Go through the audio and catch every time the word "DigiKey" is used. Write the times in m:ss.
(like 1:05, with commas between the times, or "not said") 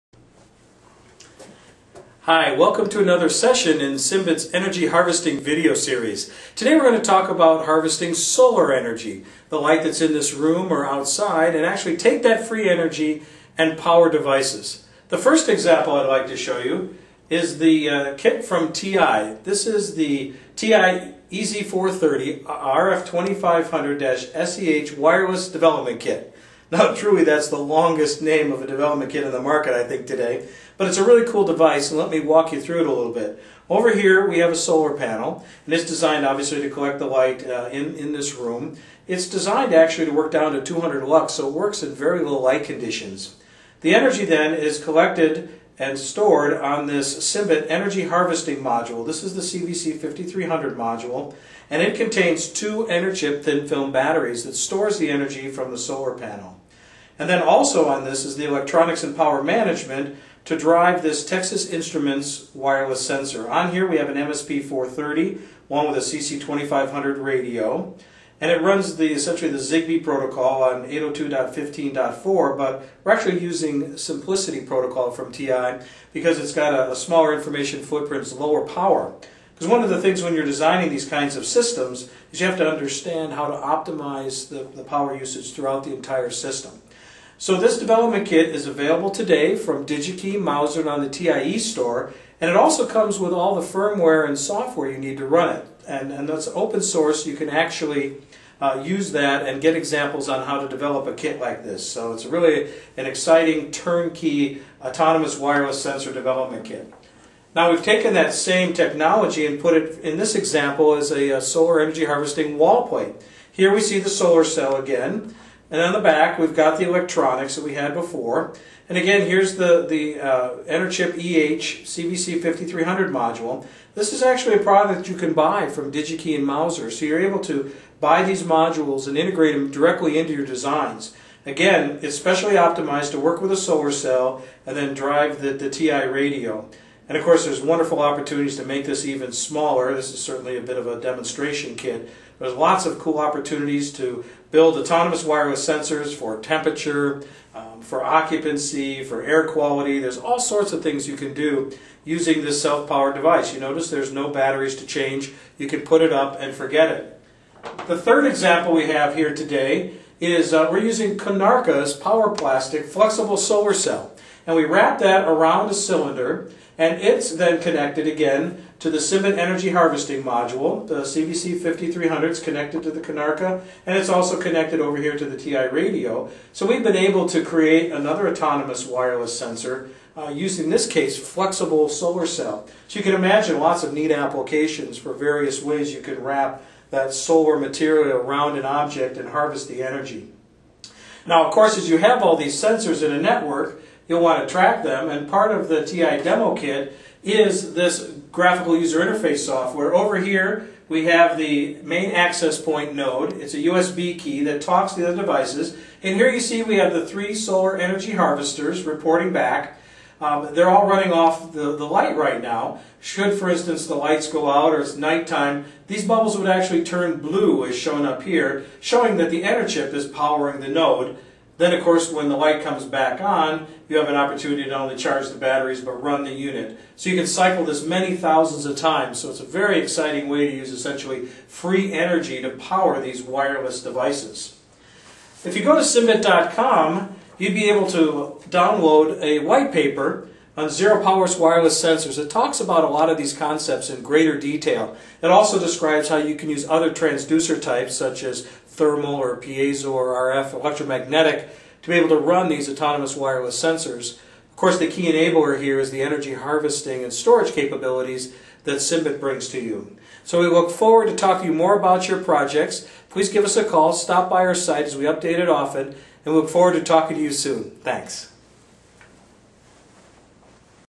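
1:29, 2:05.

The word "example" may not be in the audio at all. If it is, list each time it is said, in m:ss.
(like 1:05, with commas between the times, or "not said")
0:15, 1:39, 1:50, 2:38.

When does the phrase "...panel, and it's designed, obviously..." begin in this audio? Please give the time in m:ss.
0:34.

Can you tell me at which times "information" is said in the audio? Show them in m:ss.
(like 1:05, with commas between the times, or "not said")
1:17.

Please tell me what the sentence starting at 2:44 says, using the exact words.
And we wrap that around a cylinder, and it's then connected again to the Cymbet Energy Harvesting Module.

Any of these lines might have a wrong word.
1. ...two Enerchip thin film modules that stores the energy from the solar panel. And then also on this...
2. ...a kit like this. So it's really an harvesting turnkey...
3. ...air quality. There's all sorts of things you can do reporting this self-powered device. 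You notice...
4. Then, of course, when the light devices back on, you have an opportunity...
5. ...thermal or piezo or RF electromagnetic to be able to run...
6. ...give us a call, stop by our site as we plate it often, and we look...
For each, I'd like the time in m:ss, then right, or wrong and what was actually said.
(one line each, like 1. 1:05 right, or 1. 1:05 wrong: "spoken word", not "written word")
1. 0:52 wrong: "batteries", not "modules"
2. 1:41 wrong: "exciting", not "harvesting"
3. 2:29 wrong: "using", not "reporting"
4. 3:41 wrong: "comes", not "devices"
5. 4:08 right
6. 4:23 wrong: "update", not "plate".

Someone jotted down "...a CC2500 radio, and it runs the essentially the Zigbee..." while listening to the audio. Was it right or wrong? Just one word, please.
right.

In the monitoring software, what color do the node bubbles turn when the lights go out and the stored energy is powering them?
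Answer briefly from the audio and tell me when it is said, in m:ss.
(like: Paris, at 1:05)
Blue, at 3:37.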